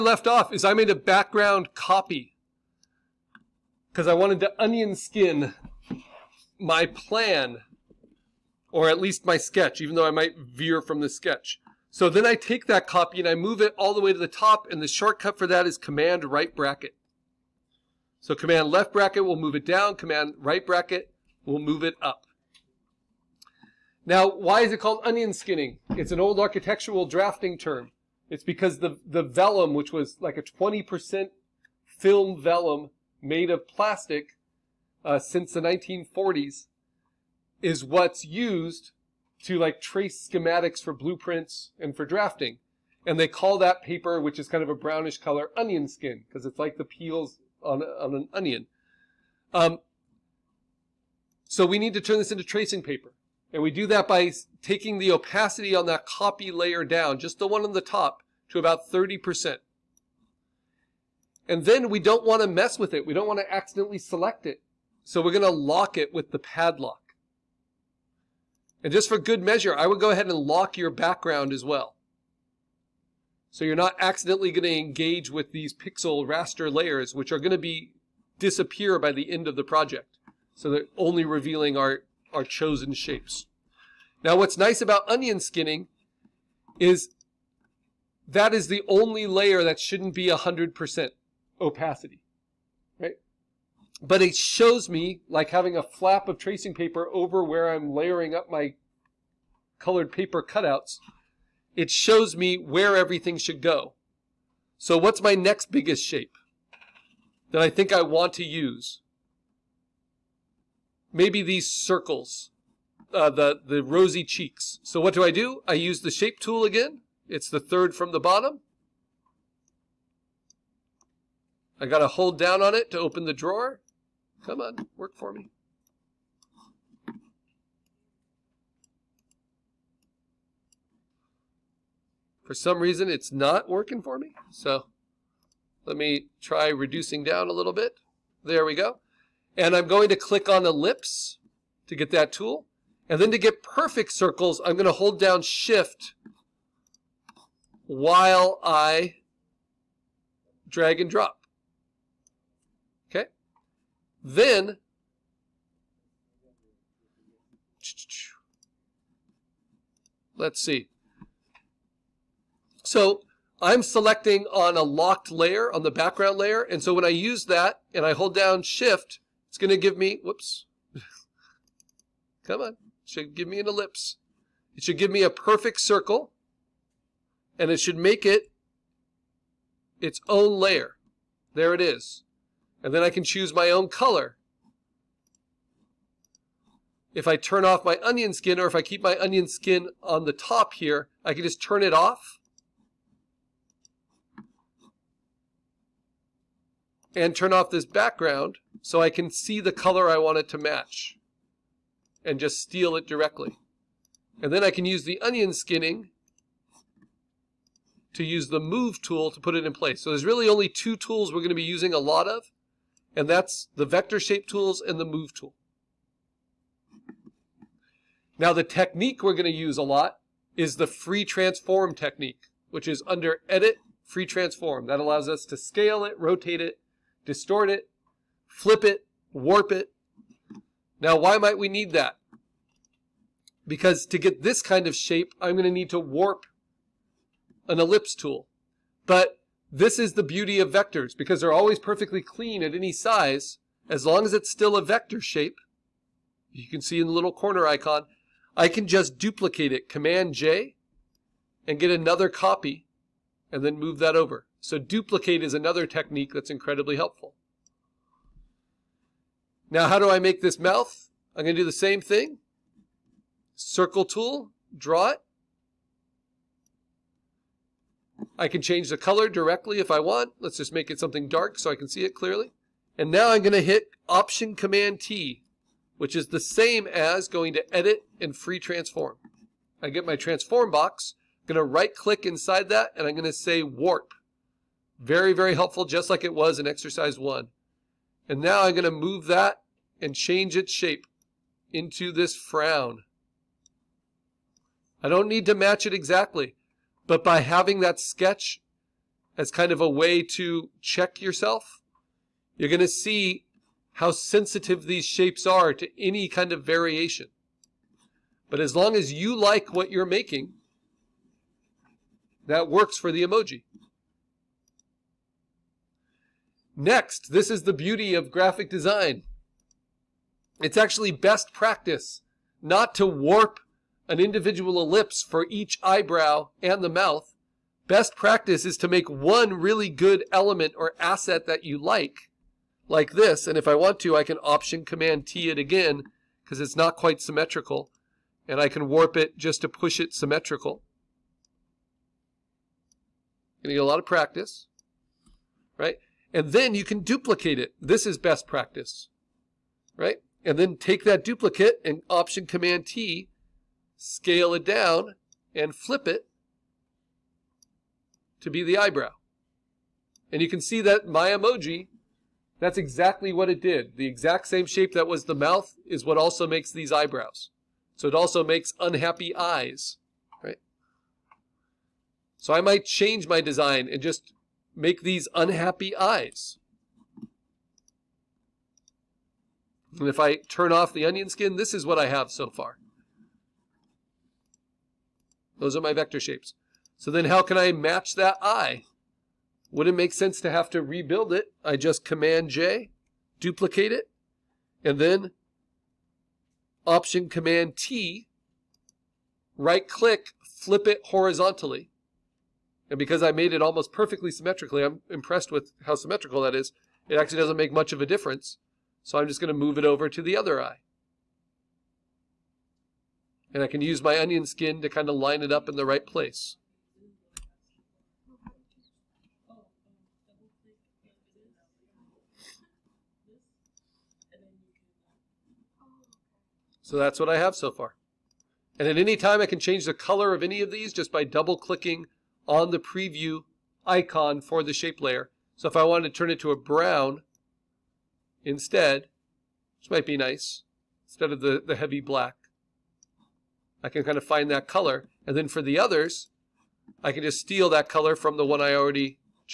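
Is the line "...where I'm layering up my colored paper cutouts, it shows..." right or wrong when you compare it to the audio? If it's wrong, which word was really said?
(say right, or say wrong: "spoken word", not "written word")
right.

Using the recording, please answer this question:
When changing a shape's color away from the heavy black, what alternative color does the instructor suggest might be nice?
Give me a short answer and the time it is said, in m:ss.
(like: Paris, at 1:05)
brown, at 7:16.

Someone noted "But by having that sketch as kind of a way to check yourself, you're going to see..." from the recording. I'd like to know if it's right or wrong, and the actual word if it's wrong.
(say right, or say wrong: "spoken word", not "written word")
right.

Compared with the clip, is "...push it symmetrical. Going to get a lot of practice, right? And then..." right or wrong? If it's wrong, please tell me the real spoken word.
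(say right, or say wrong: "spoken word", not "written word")
right.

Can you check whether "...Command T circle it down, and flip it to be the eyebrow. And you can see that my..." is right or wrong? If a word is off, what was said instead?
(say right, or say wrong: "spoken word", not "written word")
wrong: "scale", not "circle".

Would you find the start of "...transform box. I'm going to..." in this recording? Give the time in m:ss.
4:40.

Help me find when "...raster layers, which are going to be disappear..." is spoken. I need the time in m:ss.
1:16.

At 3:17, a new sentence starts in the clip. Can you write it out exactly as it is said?
And turn off this background so I can see the color I want it to match and just steal it directly.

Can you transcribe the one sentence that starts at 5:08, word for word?
But as long as you like what you're making, that works for the emoji.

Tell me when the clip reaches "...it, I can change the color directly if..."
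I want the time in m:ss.
4:25.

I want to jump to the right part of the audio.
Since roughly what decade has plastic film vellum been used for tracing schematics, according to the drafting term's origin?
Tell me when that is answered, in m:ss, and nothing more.
0:35.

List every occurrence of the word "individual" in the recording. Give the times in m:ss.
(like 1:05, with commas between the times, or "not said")
5:24.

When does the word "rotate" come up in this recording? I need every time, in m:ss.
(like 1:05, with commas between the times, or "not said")
3:46.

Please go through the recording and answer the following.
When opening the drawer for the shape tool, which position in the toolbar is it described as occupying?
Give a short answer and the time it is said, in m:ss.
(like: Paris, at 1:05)
third from the bottom, at 1:57.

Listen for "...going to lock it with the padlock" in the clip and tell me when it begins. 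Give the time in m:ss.
1:05.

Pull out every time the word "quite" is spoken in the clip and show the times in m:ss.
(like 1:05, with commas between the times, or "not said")
5:36.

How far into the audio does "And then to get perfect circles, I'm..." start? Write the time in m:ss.
2:23.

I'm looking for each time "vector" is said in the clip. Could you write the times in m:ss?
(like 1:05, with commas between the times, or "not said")
3:33, 4:00, 4:04, 6:25.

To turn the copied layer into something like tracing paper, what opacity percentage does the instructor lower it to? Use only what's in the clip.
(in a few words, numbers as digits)
30%.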